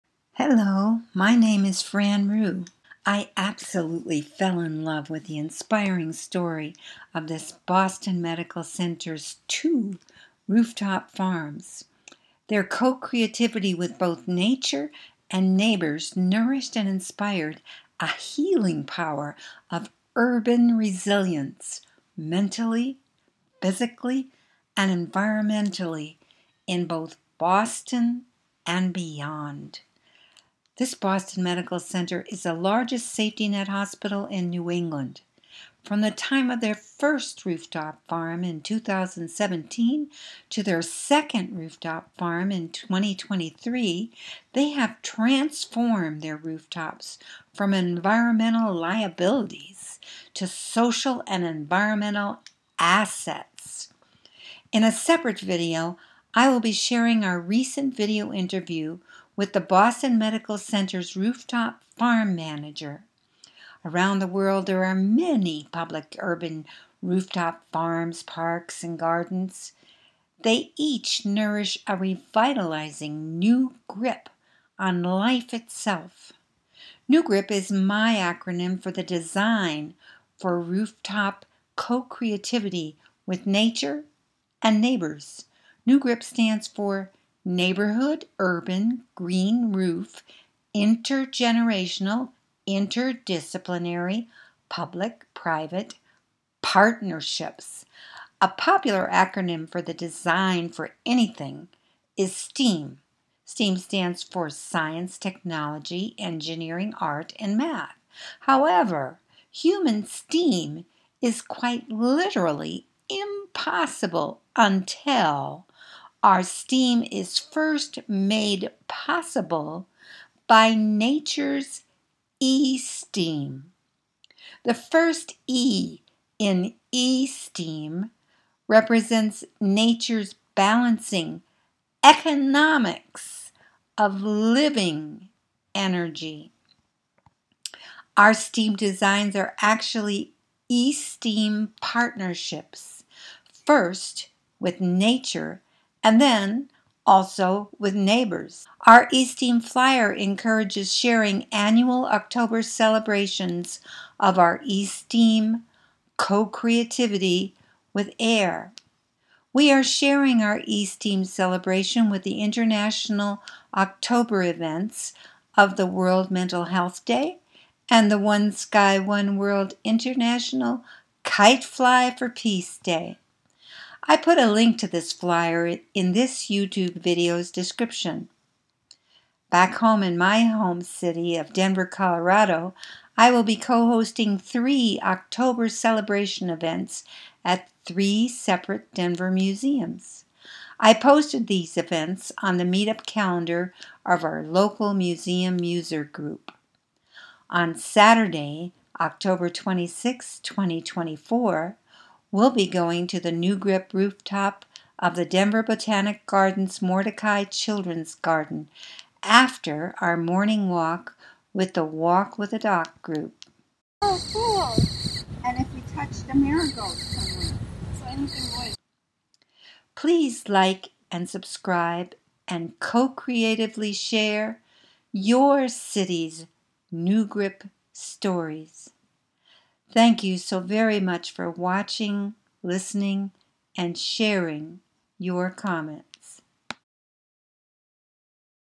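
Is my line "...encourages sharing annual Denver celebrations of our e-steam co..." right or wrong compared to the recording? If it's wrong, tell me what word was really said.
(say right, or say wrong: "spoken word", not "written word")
wrong: "October", not "Denver".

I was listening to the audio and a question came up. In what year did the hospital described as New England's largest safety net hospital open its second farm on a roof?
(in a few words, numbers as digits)
2023.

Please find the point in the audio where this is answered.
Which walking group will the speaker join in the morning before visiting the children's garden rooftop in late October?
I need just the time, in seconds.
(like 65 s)
211 s.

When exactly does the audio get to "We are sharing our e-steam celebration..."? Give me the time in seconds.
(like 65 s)
159 s.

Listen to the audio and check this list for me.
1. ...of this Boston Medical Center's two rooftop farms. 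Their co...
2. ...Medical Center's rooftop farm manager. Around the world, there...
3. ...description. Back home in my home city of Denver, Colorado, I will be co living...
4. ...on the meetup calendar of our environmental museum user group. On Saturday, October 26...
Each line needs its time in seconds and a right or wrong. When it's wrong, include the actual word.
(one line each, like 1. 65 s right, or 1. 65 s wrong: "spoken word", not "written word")
1. 7 s right
2. 60 s right
3. 177 s wrong: "hosting", not "living"
4. 192 s wrong: "local", not "environmental".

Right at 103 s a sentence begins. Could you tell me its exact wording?
STEAM stands for Science, Technology, Engineering, Art, and Math.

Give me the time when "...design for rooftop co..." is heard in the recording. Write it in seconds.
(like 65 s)
79 s.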